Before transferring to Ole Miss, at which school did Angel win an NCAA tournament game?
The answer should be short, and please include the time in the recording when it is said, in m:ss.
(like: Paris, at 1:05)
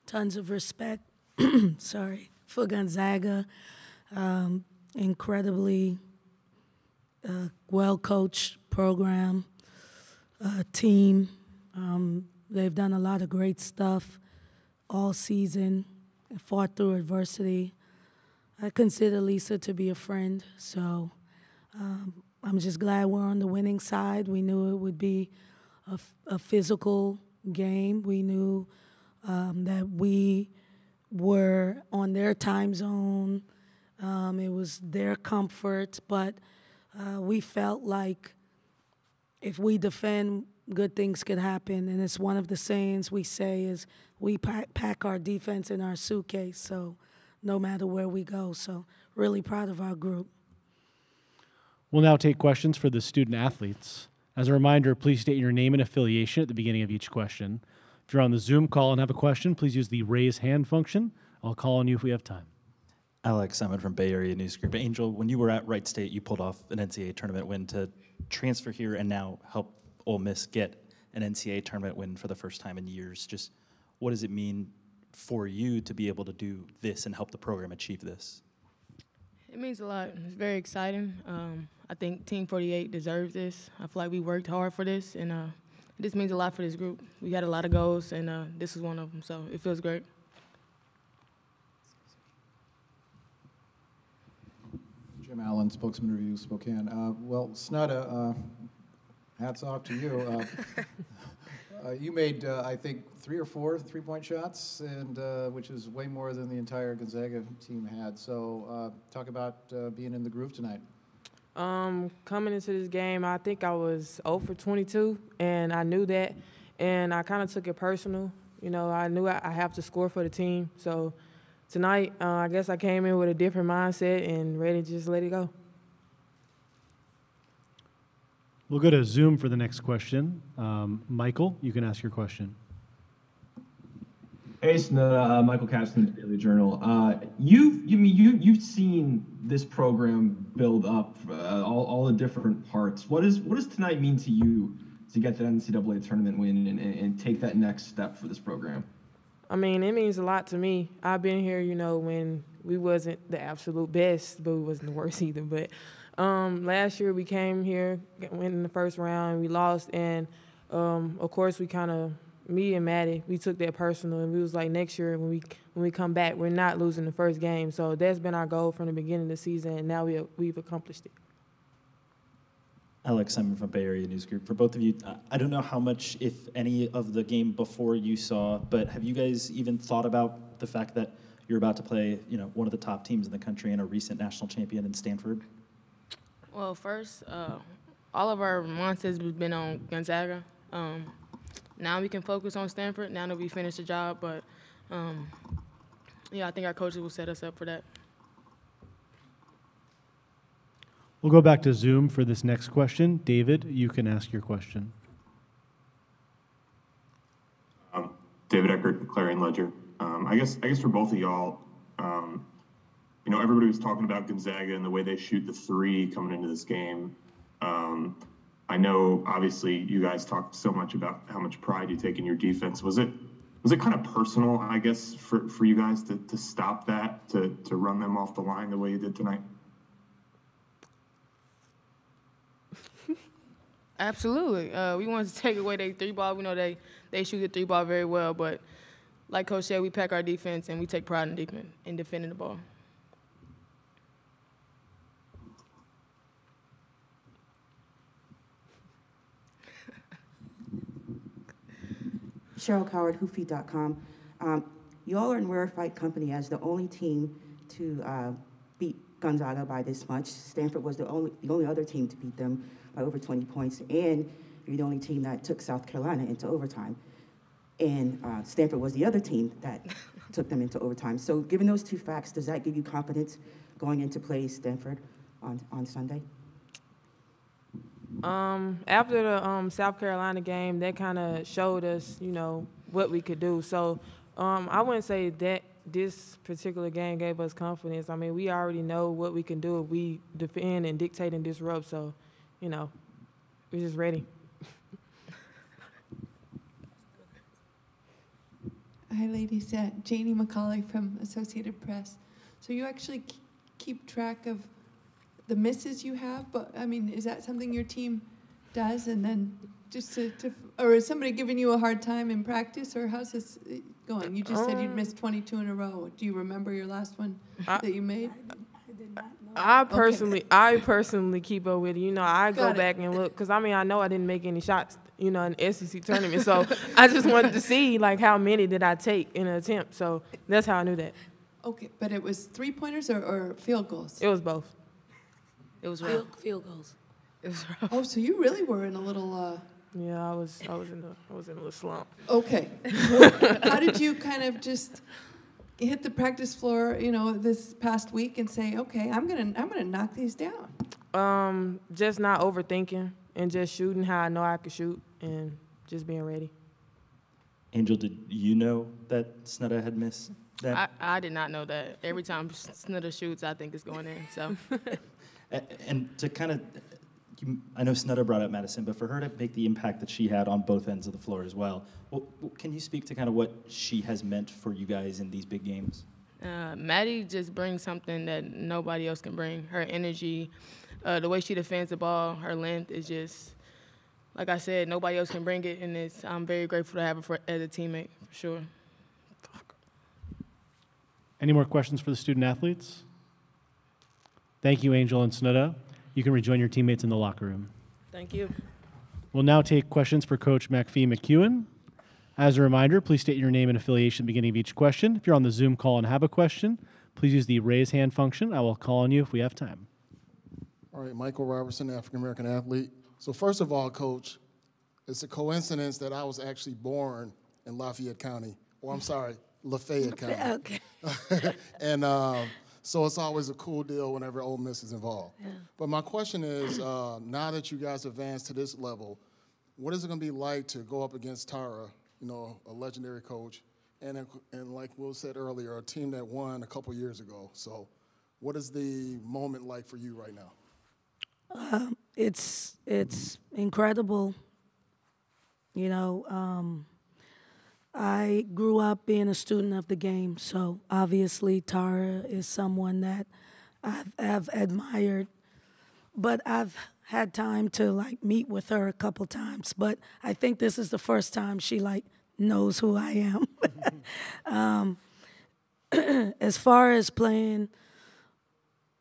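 Wright State, at 1:05.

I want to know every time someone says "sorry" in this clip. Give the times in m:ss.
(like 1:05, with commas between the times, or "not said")
0:01, 6:59.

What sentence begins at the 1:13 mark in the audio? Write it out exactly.
Just what does it mean for you to be able to do this and help the program achieve this?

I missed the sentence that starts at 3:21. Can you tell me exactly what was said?
We'll go back to Zoom for this next question.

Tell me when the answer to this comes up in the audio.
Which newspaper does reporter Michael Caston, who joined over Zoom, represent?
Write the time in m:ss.
2:16.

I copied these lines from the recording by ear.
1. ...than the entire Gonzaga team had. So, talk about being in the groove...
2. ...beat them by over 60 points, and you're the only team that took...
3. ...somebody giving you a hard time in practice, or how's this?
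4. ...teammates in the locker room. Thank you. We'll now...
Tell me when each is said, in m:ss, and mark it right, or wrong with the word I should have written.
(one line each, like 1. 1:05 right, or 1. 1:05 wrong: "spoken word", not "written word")
1. 1:46 right
2. 4:22 wrong: "20", not "60"
3. 5:11 right
4. 6:36 right.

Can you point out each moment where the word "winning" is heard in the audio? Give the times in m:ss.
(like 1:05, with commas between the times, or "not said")
0:23.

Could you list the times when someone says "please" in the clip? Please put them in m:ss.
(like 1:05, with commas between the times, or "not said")
0:54, 0:59, 6:43, 6:47.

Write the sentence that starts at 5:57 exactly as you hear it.
Angel, did you know that Snudda had missed that?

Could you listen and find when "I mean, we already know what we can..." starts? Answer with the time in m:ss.
4:48.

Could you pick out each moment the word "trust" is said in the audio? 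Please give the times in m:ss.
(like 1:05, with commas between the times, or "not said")
not said.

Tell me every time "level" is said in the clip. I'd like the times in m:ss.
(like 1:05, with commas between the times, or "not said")
7:08.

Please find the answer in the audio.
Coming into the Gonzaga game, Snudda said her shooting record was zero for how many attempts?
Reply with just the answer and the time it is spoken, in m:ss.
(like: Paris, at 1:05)
22, at 1:54.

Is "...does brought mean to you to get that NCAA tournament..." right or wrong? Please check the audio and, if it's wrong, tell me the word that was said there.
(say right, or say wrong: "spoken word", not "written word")
wrong: "tonight", not "brought".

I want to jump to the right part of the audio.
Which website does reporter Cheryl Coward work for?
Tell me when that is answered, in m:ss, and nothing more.
4:13.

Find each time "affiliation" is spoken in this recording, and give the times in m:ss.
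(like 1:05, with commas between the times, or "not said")
0:55, 6:43.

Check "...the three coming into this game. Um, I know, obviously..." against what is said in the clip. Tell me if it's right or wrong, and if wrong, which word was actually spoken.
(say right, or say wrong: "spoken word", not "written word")
right.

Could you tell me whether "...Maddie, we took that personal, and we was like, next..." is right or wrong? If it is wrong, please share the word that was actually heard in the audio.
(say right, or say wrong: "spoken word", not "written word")
right.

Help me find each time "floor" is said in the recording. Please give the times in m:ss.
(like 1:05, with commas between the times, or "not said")
5:46, 6:11.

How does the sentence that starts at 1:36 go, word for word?
Uh, well, Snudda, uh, hats off to you.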